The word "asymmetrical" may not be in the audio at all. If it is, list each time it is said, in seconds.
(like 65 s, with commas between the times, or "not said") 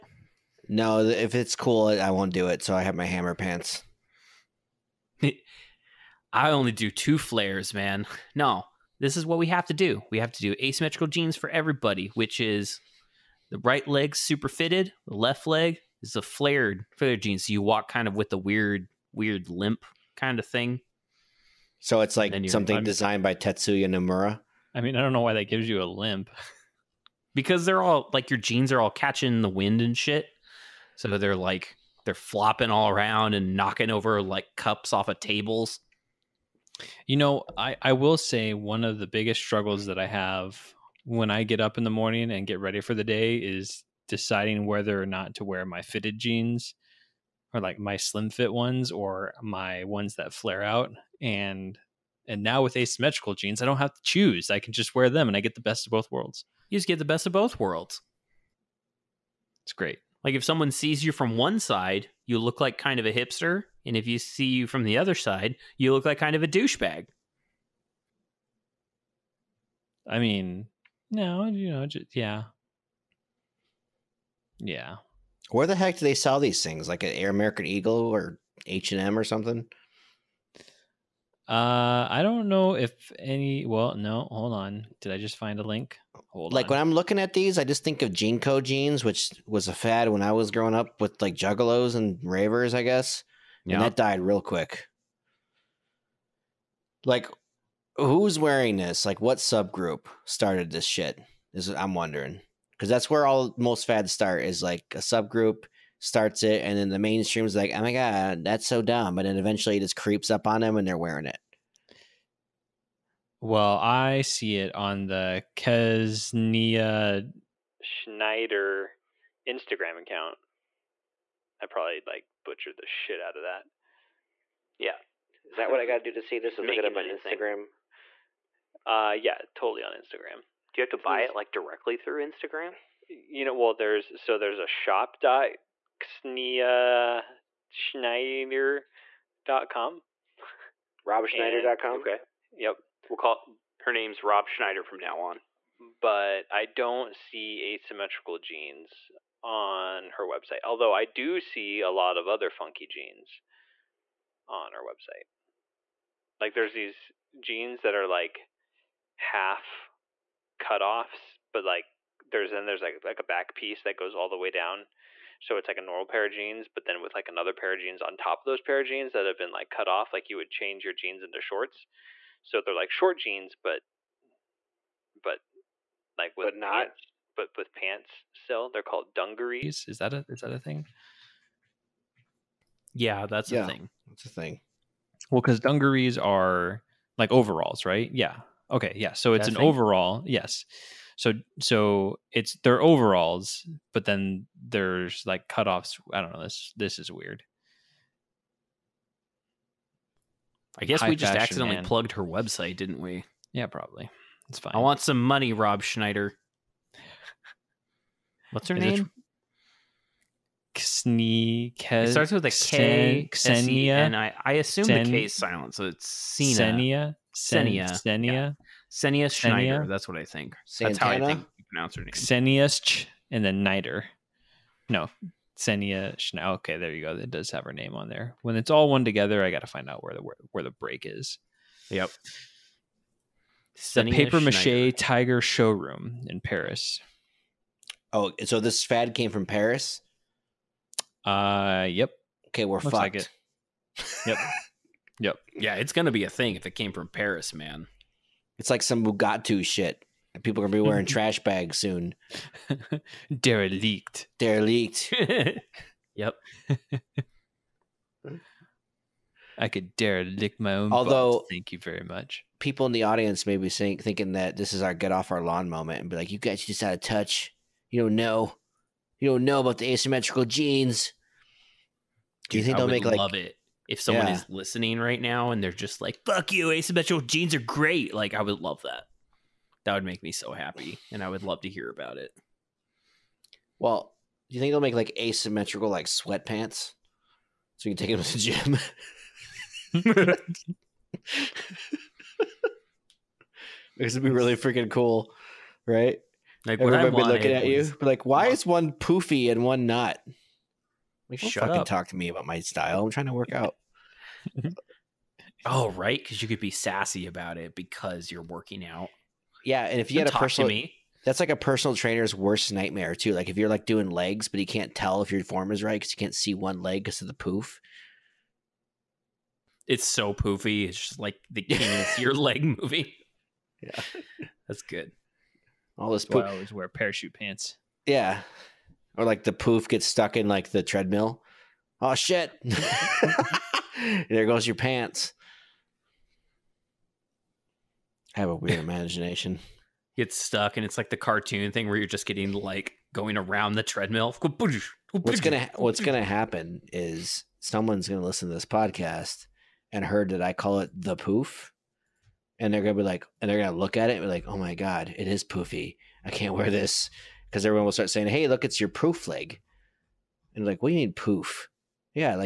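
10 s, 52 s, 147 s, 269 s, 276 s, 285 s.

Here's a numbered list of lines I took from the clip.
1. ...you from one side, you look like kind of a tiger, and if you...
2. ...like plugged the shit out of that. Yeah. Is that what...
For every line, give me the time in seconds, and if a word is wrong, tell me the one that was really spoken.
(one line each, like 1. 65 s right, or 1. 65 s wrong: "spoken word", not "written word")
1. 61 s wrong: "hipster", not "tiger"
2. 122 s wrong: "butchered", not "plugged".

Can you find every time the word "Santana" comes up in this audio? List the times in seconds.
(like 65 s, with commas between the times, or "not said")
220 s.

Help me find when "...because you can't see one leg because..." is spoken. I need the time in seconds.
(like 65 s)
315 s.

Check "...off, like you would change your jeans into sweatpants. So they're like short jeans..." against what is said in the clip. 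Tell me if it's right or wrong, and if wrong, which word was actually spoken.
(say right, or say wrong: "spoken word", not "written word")
wrong: "shorts", not "sweatpants".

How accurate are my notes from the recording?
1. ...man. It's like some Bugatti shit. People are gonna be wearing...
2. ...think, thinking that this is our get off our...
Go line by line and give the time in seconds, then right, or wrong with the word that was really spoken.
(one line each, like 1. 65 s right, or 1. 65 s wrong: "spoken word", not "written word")
1. 247 s right
2. 263 s right.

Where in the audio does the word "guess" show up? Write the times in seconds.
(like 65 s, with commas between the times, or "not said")
92 s, 200 s.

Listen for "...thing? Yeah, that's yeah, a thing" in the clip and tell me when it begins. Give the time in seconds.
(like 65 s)
180 s.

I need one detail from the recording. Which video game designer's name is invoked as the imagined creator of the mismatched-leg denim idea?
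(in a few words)
Tetsuya Nomura.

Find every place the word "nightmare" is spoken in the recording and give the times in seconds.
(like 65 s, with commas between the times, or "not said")
312 s.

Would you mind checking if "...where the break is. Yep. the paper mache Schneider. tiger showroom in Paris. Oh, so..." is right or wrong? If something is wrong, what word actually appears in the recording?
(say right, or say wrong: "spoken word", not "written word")
right.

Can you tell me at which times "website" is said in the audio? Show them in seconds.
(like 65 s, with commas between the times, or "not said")
150 s, 154 s, 202 s.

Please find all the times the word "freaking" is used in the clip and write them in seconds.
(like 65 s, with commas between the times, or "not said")
294 s.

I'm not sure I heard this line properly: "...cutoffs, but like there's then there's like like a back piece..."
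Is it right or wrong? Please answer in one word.
right.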